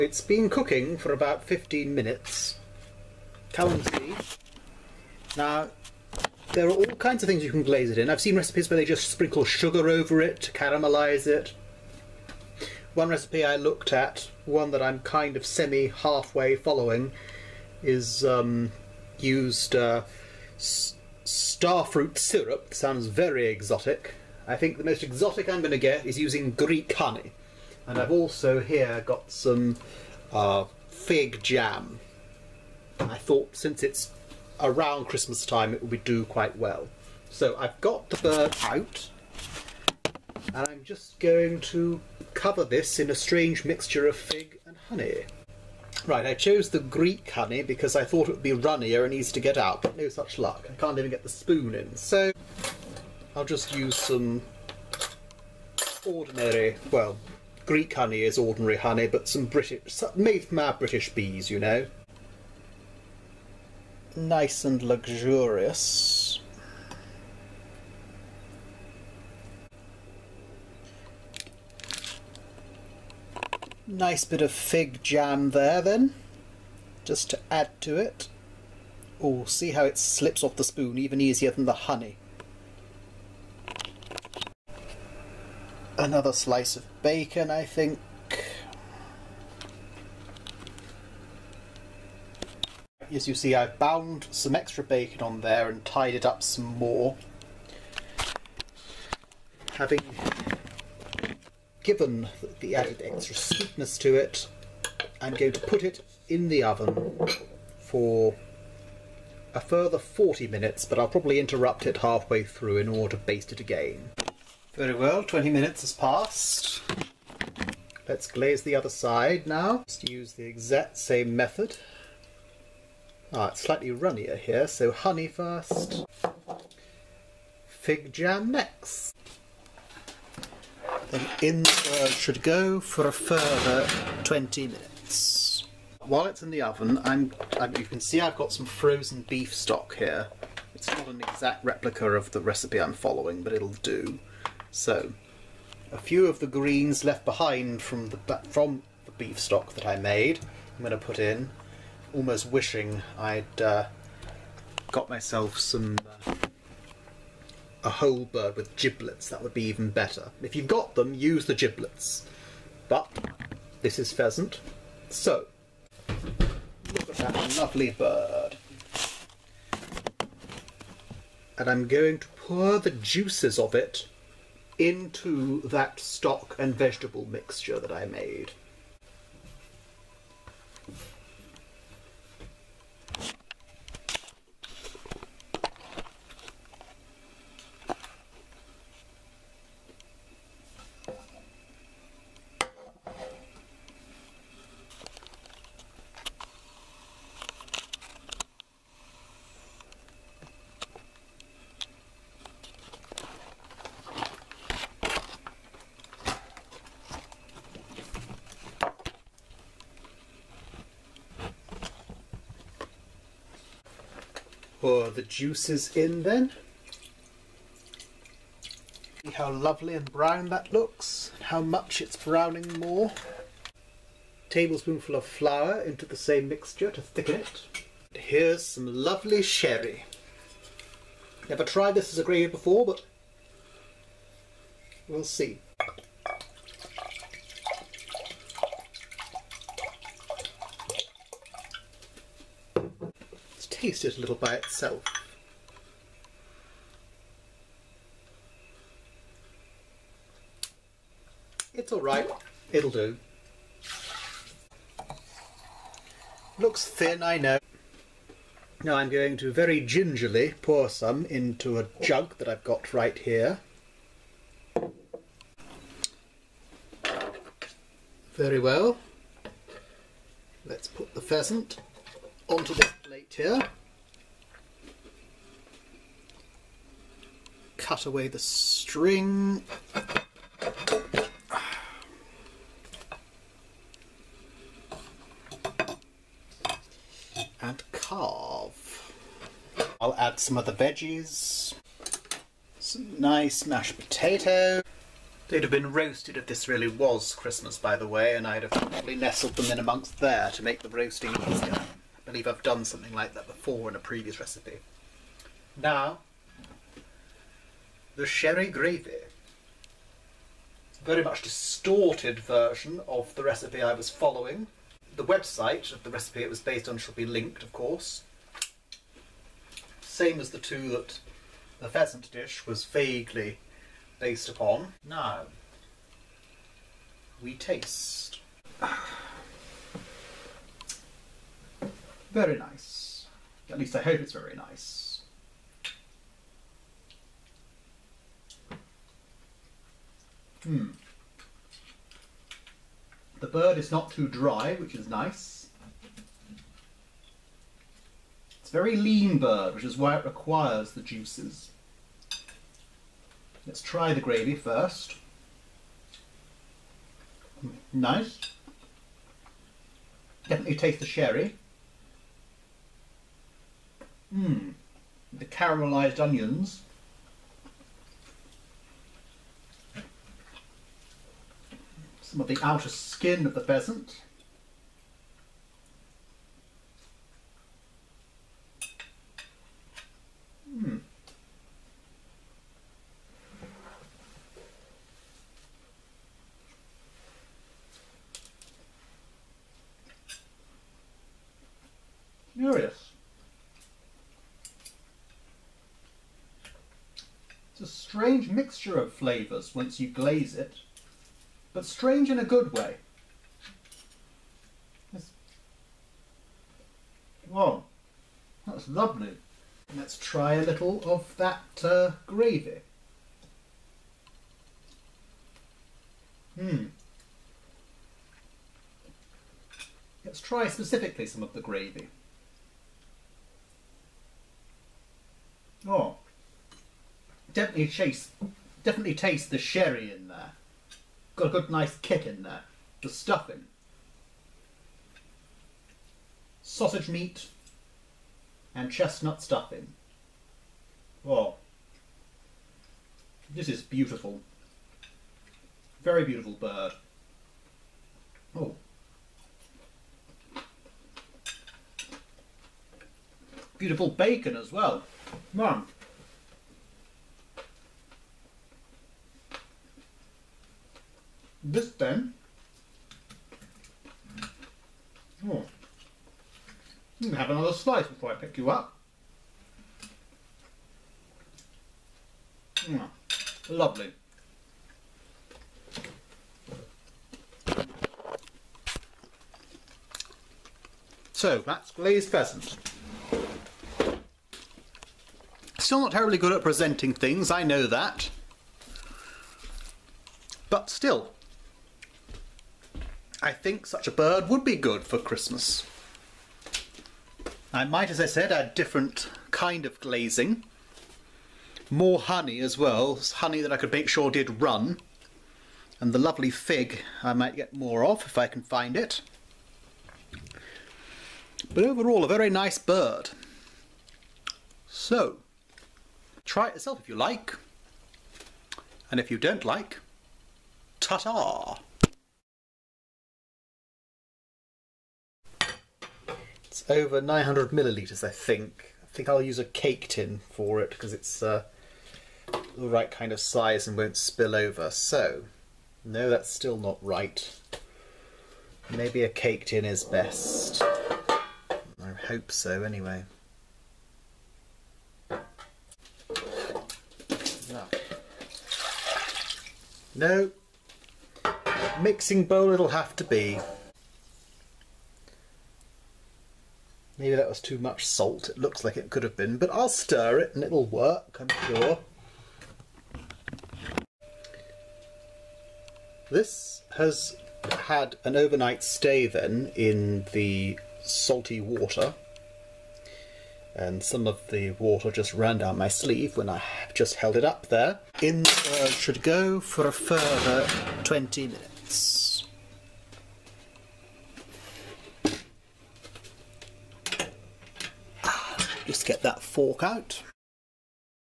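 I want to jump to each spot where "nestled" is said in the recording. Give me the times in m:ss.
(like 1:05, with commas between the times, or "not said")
4:59.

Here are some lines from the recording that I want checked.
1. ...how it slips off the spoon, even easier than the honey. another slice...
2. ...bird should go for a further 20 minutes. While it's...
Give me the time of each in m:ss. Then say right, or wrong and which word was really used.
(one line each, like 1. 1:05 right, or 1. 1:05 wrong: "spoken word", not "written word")
1. 1:19 right
2. 2:11 right.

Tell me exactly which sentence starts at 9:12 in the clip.
Mixing bowl it'll have to be.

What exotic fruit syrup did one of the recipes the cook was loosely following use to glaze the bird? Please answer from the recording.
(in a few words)
starfruit syrup.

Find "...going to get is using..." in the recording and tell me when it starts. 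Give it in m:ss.
0:25.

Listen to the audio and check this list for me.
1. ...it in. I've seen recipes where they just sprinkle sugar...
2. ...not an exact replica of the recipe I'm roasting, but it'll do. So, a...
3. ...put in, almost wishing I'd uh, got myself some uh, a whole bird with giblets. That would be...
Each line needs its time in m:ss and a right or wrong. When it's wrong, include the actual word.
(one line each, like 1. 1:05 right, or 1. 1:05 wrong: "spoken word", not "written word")
1. 0:07 right
2. 2:20 wrong: "following", not "roasting"
3. 2:30 right.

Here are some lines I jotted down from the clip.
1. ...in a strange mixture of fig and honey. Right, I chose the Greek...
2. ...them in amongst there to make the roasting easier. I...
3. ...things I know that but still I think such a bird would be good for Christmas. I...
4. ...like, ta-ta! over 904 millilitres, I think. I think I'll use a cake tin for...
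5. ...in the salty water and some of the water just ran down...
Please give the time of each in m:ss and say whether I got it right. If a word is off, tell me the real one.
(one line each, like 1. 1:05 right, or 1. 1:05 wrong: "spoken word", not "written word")
1. 0:42 right
2. 4:59 right
3. 8:07 right
4. 8:39 wrong: "900", not "904"
5. 9:29 right.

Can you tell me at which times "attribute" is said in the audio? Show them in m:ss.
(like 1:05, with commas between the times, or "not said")
not said.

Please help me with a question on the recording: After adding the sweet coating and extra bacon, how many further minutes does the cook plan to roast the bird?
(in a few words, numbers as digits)
40 minutes.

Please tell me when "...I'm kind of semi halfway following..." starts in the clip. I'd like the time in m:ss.
0:14.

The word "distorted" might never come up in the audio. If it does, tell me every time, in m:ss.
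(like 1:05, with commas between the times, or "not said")
5:11.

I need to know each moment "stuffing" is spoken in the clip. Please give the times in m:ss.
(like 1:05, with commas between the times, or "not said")
7:13, 7:19.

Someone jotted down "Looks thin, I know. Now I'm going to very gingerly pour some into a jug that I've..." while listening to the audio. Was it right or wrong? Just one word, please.
right.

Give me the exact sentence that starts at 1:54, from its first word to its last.
Very well, 20 minutes has passed.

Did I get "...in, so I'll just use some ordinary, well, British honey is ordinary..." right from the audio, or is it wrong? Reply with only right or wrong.
wrong.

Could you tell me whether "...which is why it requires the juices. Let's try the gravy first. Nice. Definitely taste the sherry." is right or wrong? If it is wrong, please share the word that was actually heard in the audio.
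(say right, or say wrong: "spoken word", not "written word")
right.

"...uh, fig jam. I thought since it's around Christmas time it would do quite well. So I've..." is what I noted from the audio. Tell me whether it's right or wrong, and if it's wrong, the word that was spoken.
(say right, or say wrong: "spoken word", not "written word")
right.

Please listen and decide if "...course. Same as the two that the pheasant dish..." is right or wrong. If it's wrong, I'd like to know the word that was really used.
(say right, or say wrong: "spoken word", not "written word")
right.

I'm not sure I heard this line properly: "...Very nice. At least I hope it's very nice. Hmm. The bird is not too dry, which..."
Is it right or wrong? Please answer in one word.
right.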